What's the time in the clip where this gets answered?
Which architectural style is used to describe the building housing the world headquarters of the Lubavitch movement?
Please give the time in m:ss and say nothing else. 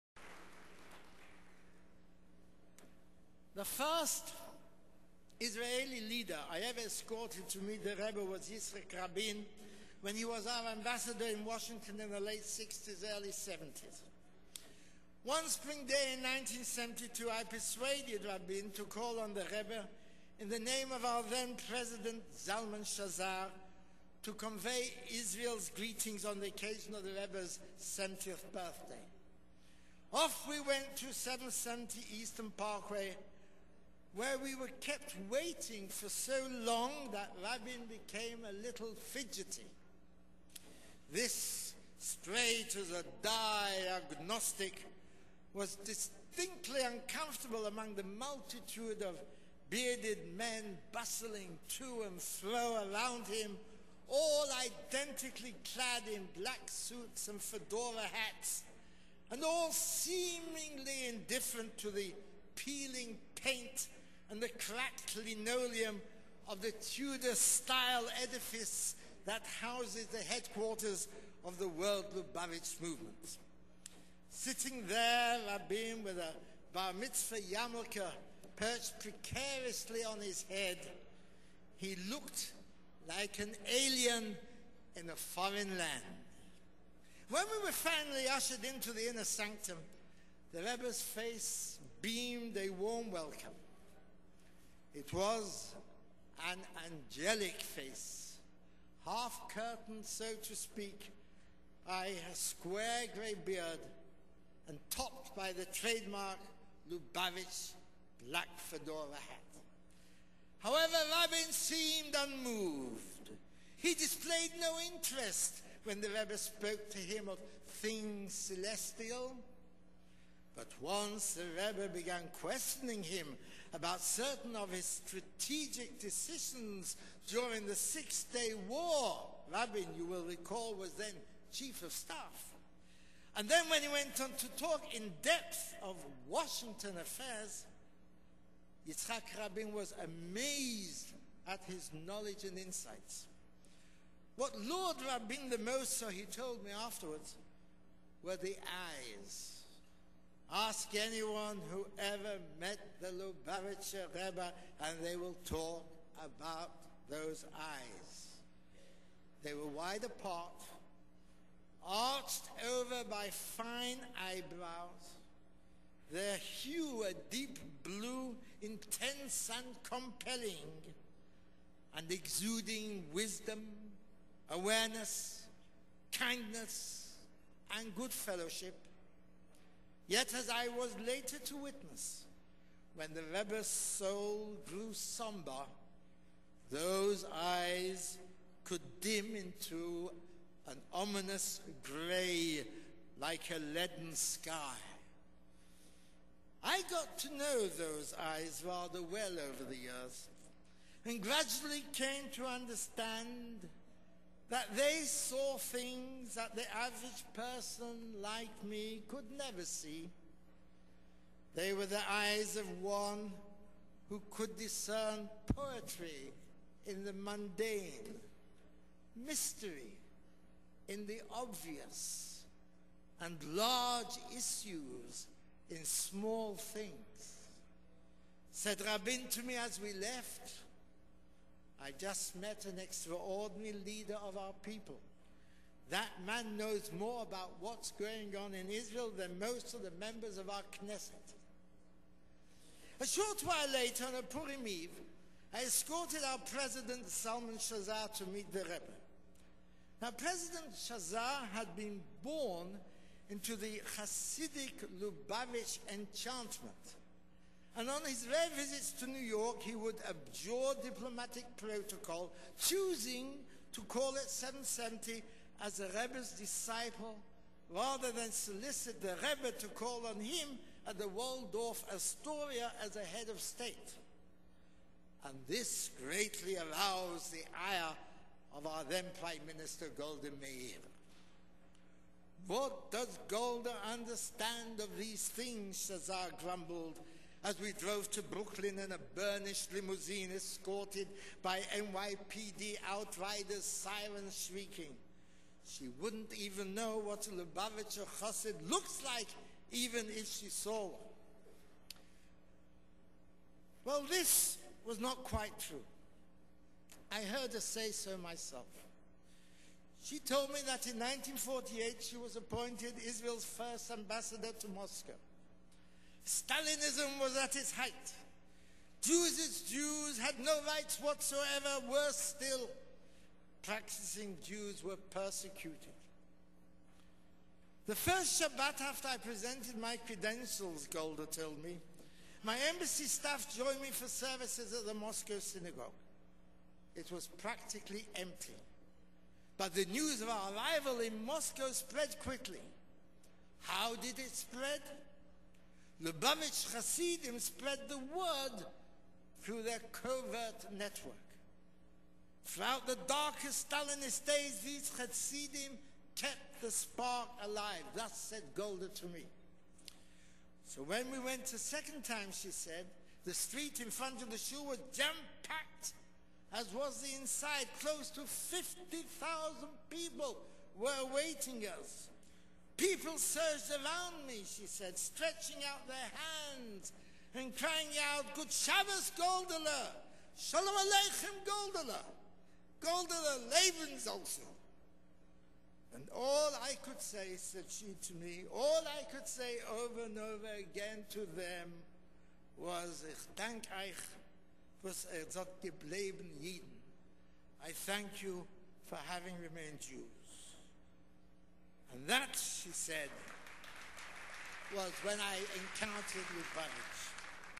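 1:06.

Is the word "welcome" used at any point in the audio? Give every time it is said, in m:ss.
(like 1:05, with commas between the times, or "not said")
1:33.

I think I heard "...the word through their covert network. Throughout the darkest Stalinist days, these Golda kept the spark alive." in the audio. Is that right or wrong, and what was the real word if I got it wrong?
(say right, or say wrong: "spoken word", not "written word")
wrong: "Hasidim", not "Golda".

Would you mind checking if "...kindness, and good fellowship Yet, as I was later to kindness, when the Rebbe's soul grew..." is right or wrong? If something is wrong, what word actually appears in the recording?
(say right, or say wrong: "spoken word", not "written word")
wrong: "witness", not "kindness".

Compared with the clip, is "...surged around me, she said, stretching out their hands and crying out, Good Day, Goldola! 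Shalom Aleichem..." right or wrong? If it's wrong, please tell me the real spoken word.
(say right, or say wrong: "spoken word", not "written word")
wrong: "Shabbos", not "Day".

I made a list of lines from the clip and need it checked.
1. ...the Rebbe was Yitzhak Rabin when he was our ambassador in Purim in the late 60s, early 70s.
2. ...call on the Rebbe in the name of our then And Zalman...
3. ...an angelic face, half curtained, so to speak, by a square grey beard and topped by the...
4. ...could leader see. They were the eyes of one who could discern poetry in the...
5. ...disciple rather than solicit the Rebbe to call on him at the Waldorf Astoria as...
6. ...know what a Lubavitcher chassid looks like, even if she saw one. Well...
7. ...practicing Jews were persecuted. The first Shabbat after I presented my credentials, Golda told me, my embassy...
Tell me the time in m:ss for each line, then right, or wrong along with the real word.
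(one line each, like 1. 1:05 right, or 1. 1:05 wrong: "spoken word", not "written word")
1. 0:07 wrong: "Washington", not "Purim"
2. 0:18 wrong: "President", not "And"
3. 1:36 right
4. 3:29 wrong: "never", not "leader"
5. 4:26 right
6. 4:56 right
7. 5:23 right.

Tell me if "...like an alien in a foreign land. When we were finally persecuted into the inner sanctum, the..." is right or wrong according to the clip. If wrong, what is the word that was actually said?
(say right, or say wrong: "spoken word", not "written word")
wrong: "ushered", not "persecuted".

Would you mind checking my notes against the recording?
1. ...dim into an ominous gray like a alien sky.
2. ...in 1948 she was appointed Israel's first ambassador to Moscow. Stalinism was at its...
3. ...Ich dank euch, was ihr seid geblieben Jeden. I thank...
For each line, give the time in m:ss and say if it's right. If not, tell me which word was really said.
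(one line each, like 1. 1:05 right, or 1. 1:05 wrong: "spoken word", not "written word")
1. 3:08 wrong: "leaden", not "alien"
2. 5:10 right
3. 6:33 right.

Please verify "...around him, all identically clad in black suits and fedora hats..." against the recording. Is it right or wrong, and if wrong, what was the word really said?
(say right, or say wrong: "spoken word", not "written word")
right.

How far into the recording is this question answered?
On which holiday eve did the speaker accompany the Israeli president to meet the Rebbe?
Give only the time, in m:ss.
4:04.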